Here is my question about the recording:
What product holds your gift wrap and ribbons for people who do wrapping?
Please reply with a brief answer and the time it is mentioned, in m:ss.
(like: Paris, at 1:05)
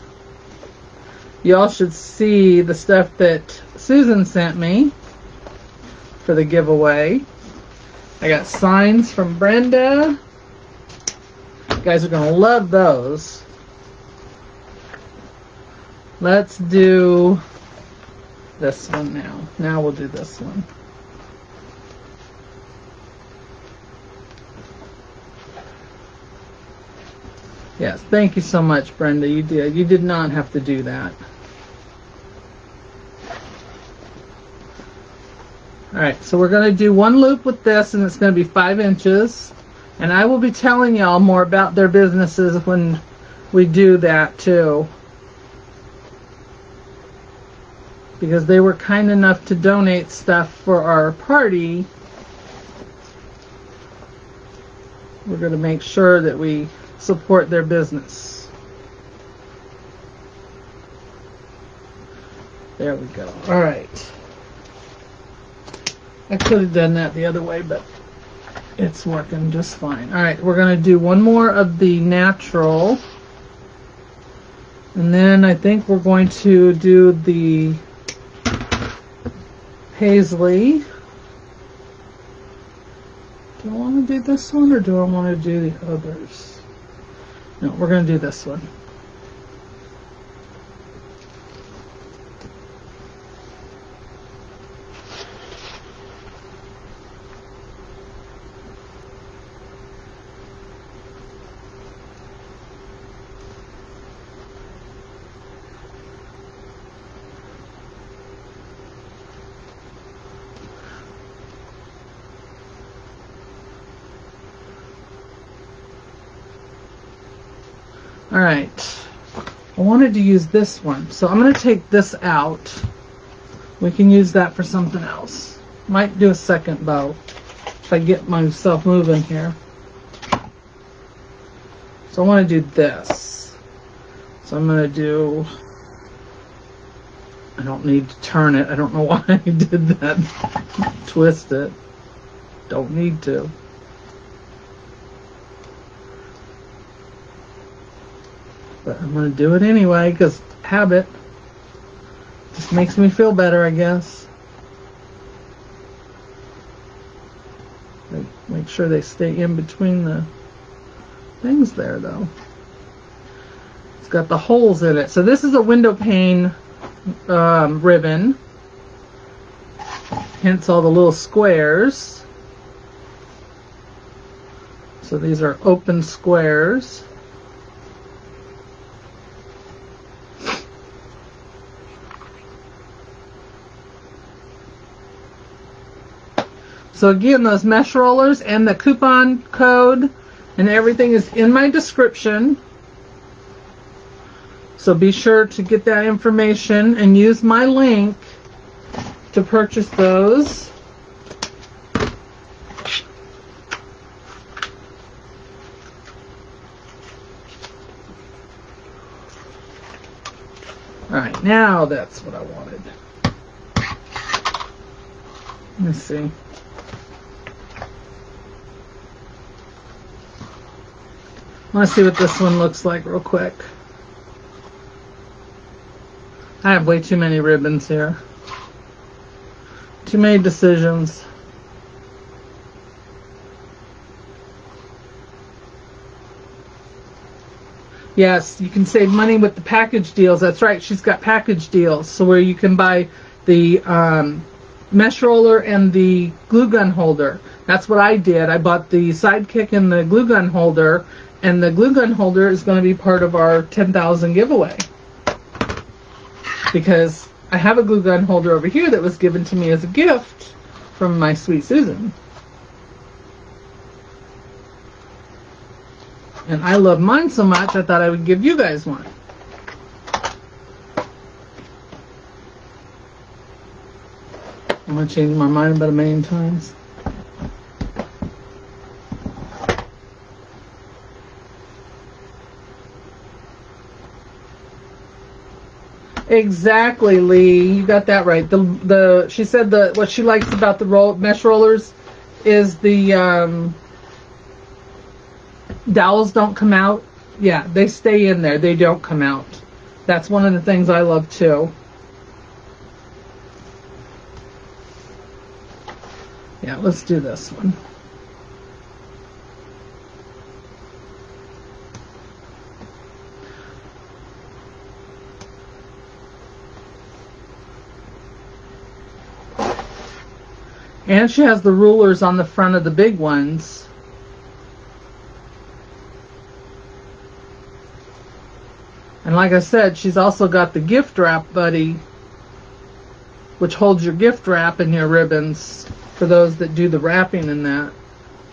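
Gift wrap buddy, at 5:30.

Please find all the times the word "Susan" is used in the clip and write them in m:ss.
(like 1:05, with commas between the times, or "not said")
0:03, 4:21.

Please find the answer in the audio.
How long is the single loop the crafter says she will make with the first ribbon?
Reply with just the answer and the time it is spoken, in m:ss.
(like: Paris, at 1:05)
5 inches, at 0:38.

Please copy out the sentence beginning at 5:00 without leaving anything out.
That's one of the things I love too.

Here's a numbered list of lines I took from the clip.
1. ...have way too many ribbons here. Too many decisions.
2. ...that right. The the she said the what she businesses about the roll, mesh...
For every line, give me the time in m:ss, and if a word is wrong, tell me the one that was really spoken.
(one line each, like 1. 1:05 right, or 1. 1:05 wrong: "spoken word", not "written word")
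1. 3:46 right
2. 4:48 wrong: "likes", not "businesses".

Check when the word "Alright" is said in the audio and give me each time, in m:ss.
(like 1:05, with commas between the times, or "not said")
3:31.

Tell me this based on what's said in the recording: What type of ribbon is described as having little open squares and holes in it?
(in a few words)
Window pane.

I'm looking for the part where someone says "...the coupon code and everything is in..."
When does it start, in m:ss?
3:08.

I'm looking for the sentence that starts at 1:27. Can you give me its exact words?
No, we're going to do this one.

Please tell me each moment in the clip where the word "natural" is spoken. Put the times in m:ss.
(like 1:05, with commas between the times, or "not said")
1:11.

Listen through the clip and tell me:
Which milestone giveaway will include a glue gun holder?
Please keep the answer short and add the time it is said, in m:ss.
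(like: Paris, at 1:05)
10,000, at 4:13.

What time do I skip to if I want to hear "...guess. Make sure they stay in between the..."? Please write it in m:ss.
2:33.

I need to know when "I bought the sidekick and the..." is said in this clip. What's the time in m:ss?
4:08.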